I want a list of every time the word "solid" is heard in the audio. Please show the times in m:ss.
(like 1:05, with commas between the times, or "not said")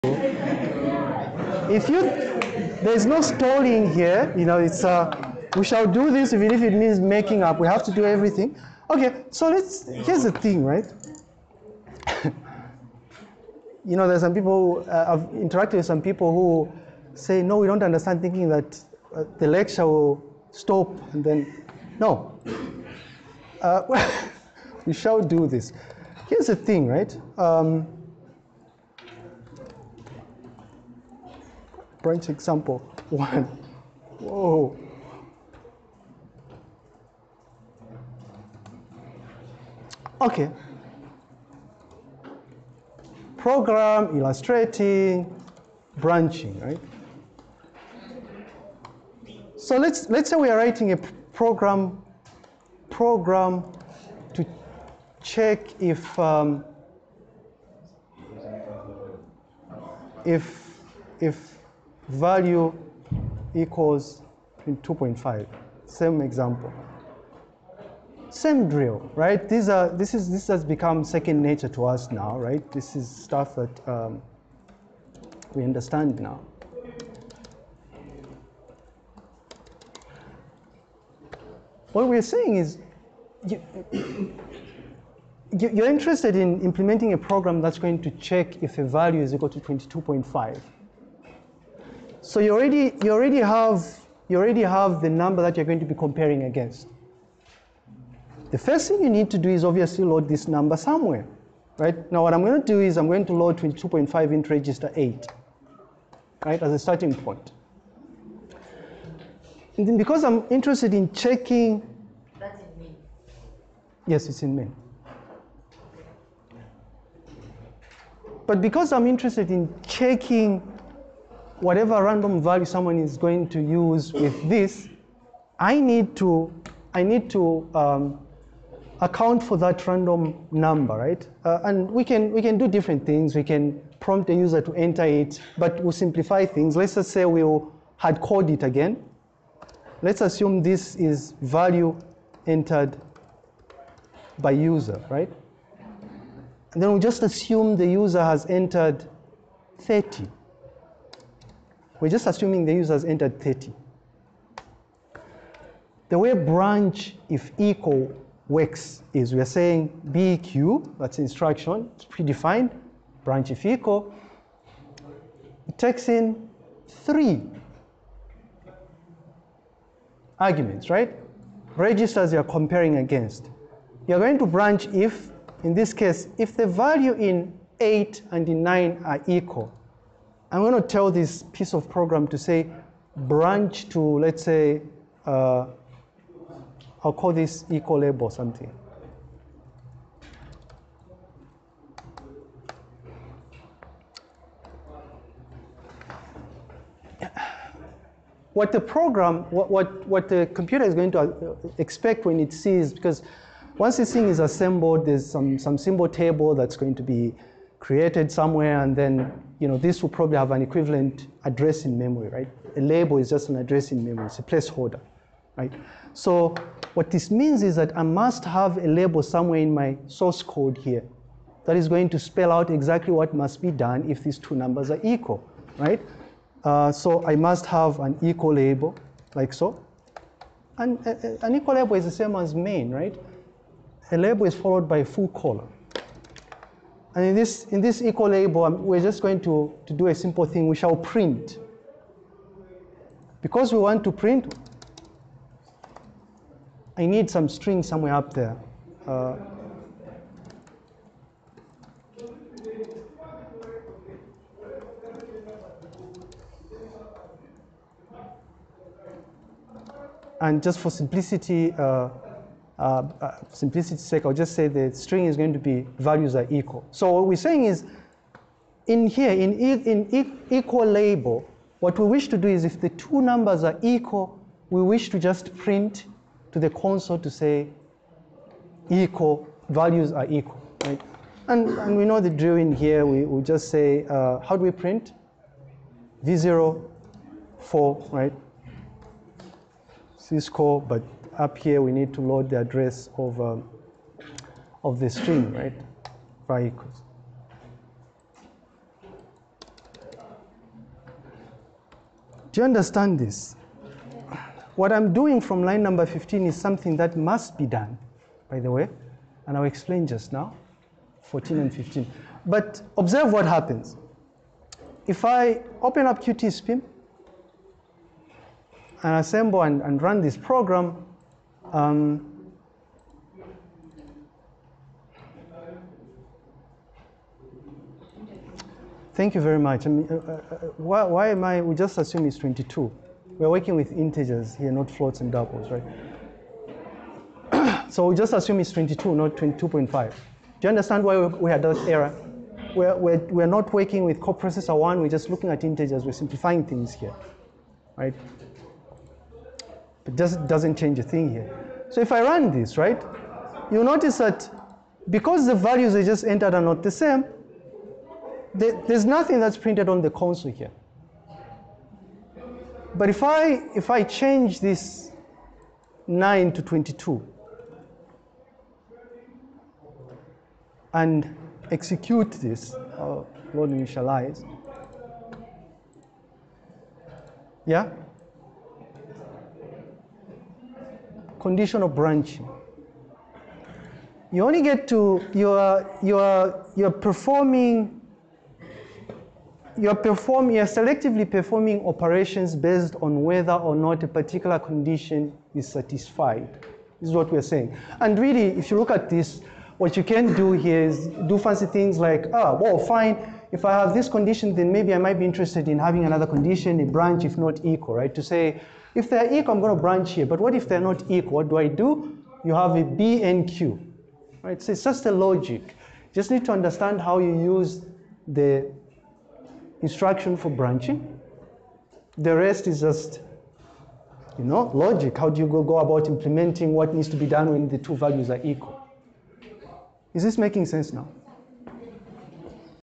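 not said.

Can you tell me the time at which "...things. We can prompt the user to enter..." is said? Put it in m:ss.
2:13.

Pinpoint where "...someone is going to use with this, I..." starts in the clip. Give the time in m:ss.
2:02.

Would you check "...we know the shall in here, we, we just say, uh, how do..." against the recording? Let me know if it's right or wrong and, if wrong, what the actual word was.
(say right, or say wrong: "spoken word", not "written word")
wrong: "drill", not "shall".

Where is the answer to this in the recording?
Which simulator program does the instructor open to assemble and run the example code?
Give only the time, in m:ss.
5:16.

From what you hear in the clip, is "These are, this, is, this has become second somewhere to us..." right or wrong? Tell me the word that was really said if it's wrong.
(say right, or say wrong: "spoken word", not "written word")
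wrong: "nature", not "somewhere".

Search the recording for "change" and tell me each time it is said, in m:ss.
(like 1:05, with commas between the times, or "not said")
5:50, 6:04.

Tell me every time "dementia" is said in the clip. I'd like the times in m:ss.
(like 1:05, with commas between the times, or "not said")
not said.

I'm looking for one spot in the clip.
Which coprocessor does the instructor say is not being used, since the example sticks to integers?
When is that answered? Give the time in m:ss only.
5:44.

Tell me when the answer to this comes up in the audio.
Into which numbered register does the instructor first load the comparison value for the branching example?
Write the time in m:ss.
1:44.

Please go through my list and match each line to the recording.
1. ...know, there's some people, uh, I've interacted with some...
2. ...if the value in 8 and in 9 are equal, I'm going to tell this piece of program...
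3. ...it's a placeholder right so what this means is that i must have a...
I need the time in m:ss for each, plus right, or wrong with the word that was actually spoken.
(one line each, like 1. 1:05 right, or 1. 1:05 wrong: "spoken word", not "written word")
1. 0:13 right
2. 2:56 right
3. 3:34 right.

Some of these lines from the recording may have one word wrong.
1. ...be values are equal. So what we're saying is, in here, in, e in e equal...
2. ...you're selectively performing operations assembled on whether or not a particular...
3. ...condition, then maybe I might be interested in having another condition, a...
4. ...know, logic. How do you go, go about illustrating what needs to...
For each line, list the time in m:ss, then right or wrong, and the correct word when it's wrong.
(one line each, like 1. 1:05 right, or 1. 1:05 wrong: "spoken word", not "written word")
1. 4:25 right
2. 6:30 wrong: "based", not "assembled"
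3. 6:44 right
4. 7:04 wrong: "implementing", not "illustrating".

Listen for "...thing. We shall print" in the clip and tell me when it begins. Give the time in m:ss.
4:00.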